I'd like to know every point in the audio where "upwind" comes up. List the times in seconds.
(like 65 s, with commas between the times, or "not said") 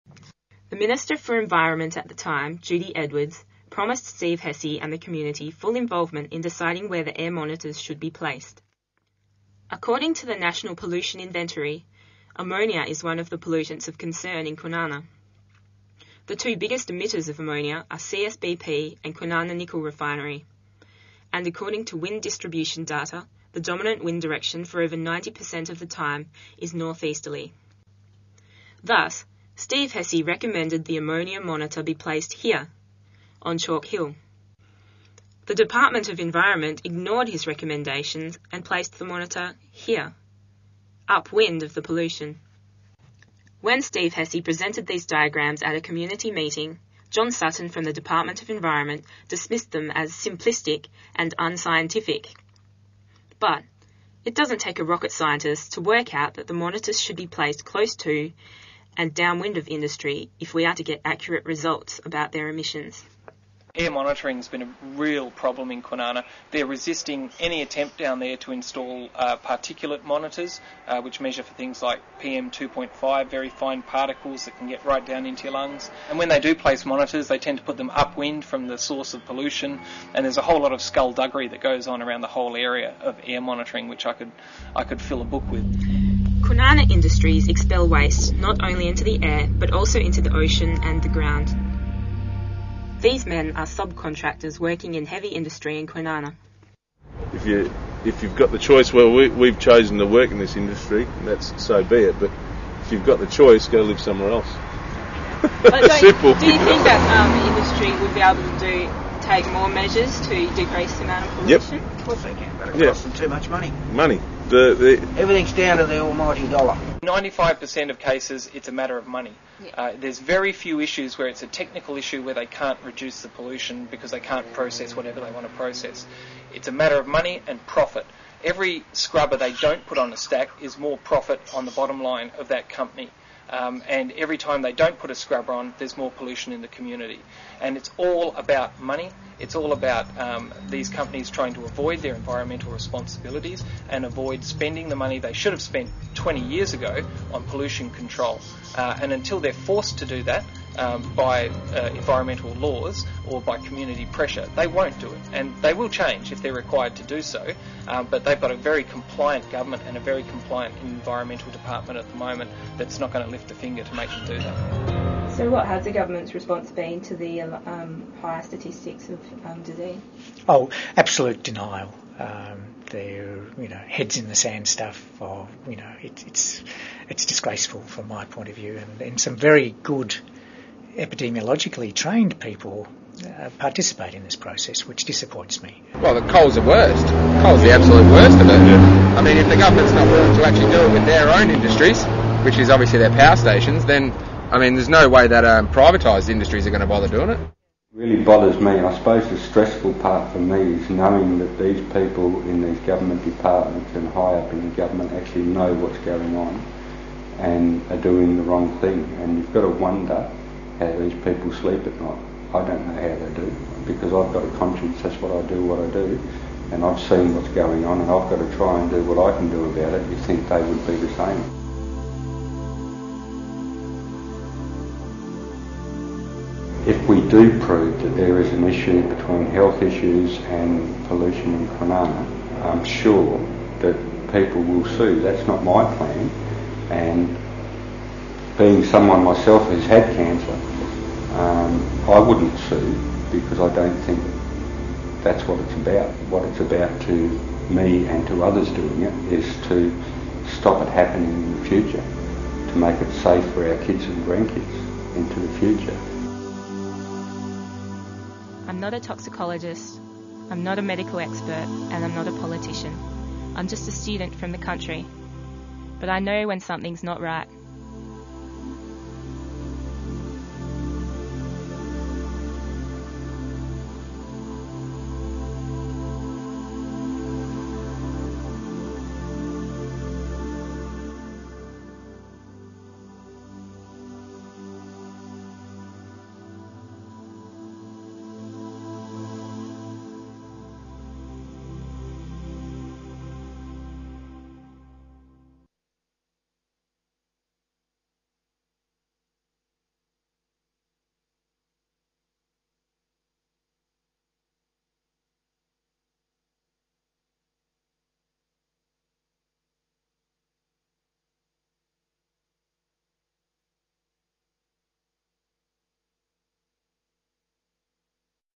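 41 s, 77 s.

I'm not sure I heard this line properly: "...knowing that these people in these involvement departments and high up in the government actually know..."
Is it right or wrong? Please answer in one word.
wrong.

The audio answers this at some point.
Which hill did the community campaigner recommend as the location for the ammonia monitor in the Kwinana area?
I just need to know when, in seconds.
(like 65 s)
33 s.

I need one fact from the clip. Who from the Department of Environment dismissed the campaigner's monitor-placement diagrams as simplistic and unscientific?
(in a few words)
John Sutton.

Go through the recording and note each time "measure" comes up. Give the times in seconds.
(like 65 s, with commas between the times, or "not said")
71 s, 109 s.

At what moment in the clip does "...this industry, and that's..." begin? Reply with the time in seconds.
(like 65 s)
100 s.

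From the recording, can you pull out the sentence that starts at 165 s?
So, what has the government's response been to the um, higher statistics of um, disease?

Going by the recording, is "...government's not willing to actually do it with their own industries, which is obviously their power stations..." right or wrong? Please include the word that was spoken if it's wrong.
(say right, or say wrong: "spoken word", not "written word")
right.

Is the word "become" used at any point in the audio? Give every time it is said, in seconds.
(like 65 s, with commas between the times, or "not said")
not said.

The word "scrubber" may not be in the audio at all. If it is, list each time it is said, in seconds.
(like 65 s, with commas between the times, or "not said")
128 s, 135 s.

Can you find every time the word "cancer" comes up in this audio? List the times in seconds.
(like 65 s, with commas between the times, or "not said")
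240 s.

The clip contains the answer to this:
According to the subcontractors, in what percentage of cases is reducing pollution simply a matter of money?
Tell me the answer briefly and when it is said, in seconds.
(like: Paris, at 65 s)
95%, at 117 s.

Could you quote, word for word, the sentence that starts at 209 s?
And you've got to wonder how these people sleep at night.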